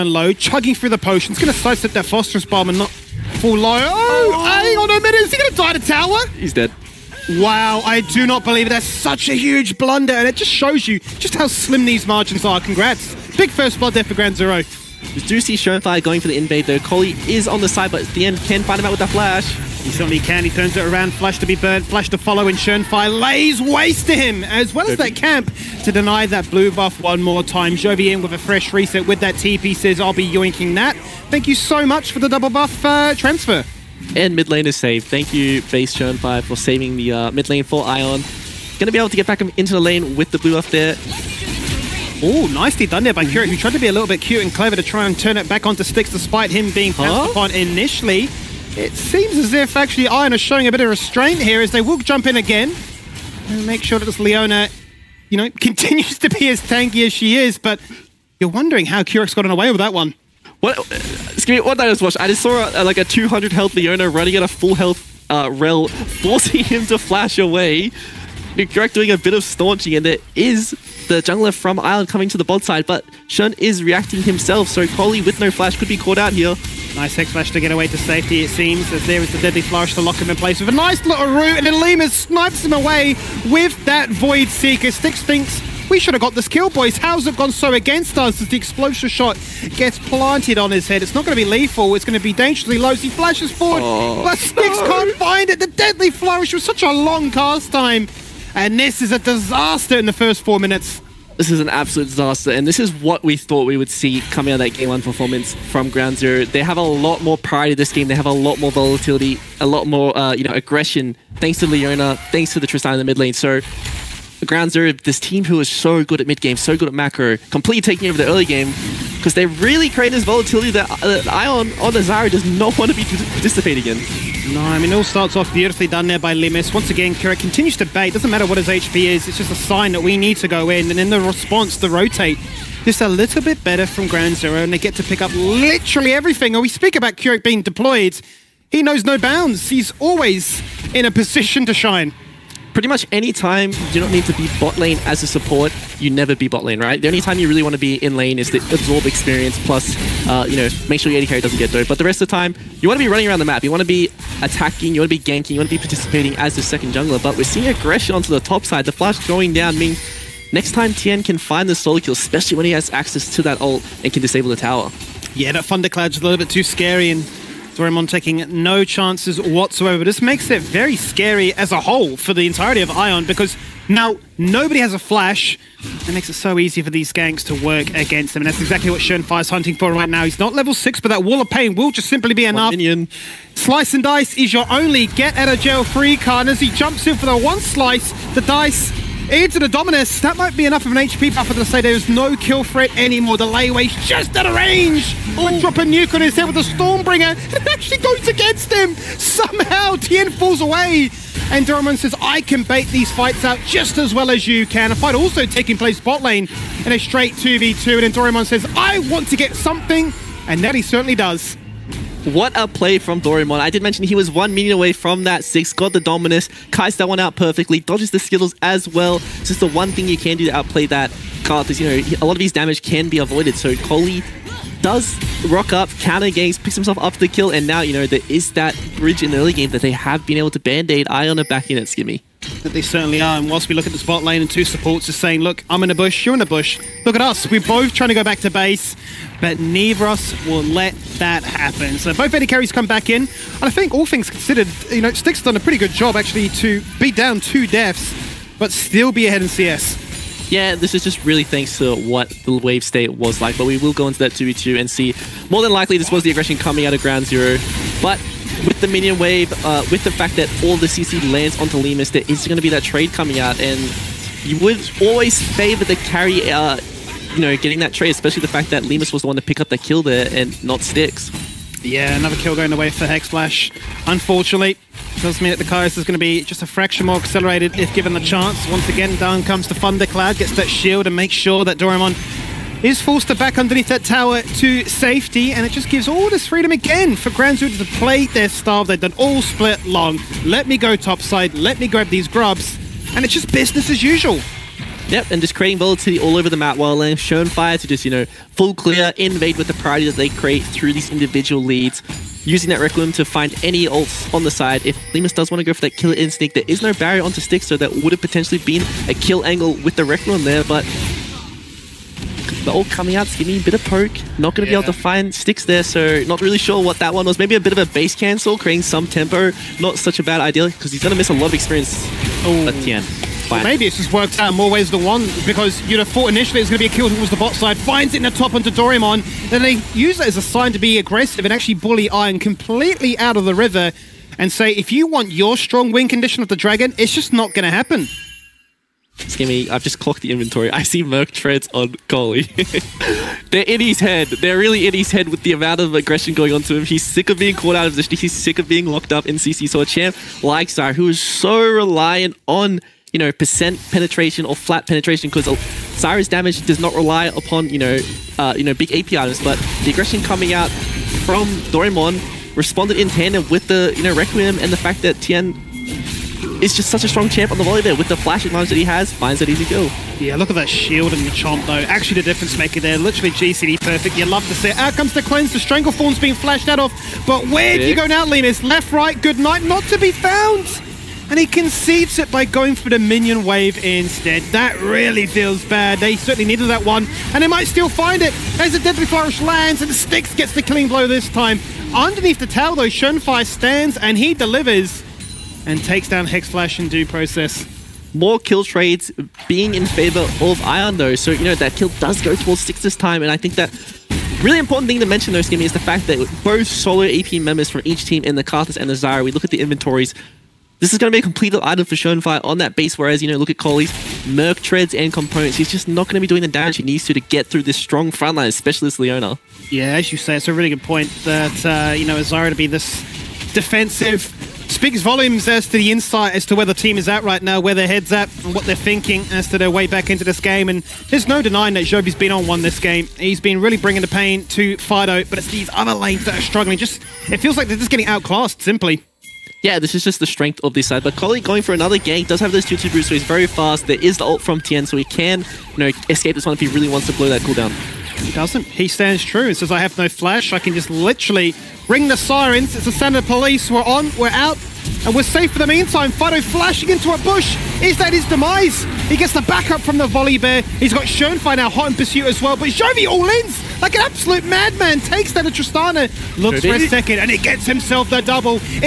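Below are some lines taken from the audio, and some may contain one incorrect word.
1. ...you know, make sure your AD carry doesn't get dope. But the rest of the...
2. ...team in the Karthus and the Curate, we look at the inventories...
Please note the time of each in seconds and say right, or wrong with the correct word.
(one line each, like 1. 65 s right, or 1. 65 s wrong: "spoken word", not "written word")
1. 150 s right
2. 408 s wrong: "Zyra", not "Curate".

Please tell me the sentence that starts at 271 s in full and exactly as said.
Yeah, another kill going away for Hexflash.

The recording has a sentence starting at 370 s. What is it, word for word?
Yeah, look at that shield and the chomp, though.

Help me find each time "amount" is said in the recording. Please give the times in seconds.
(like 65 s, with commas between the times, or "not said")
345 s.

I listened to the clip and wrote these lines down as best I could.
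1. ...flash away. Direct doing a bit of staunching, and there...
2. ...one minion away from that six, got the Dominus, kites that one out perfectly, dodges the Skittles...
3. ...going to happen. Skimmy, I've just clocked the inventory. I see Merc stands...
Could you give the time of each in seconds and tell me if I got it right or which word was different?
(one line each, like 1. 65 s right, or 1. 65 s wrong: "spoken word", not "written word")
1. 66 s right
2. 214 s right
3. 337 s wrong: "treads", not "stands".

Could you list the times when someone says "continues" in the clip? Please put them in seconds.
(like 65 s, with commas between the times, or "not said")
55 s, 127 s.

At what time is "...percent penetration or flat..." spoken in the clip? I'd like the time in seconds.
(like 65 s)
353 s.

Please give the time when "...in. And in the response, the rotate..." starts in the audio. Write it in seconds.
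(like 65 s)
130 s.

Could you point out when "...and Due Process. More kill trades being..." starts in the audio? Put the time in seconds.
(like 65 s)
396 s.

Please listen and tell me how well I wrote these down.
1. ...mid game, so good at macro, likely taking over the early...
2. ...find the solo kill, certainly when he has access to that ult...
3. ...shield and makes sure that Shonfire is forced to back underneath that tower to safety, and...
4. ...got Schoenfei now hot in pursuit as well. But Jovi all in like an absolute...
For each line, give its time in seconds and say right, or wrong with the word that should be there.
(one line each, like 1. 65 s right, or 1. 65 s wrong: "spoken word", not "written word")
1. 116 s wrong: "completely", not "likely"
2. 161 s wrong: "especially", not "certainly"
3. 280 s wrong: "Doraemon", not "Shonfire"
4. 460 s right.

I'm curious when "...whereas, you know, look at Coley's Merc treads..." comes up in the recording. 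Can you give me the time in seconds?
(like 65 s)
412 s.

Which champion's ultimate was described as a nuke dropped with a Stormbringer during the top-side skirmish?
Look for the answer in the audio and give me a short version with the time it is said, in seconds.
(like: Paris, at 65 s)
Volibear, at 195 s.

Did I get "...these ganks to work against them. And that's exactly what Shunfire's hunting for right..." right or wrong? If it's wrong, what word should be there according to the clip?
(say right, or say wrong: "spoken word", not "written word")
right.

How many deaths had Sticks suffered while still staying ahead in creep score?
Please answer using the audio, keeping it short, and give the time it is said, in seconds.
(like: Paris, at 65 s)
2, at 247 s.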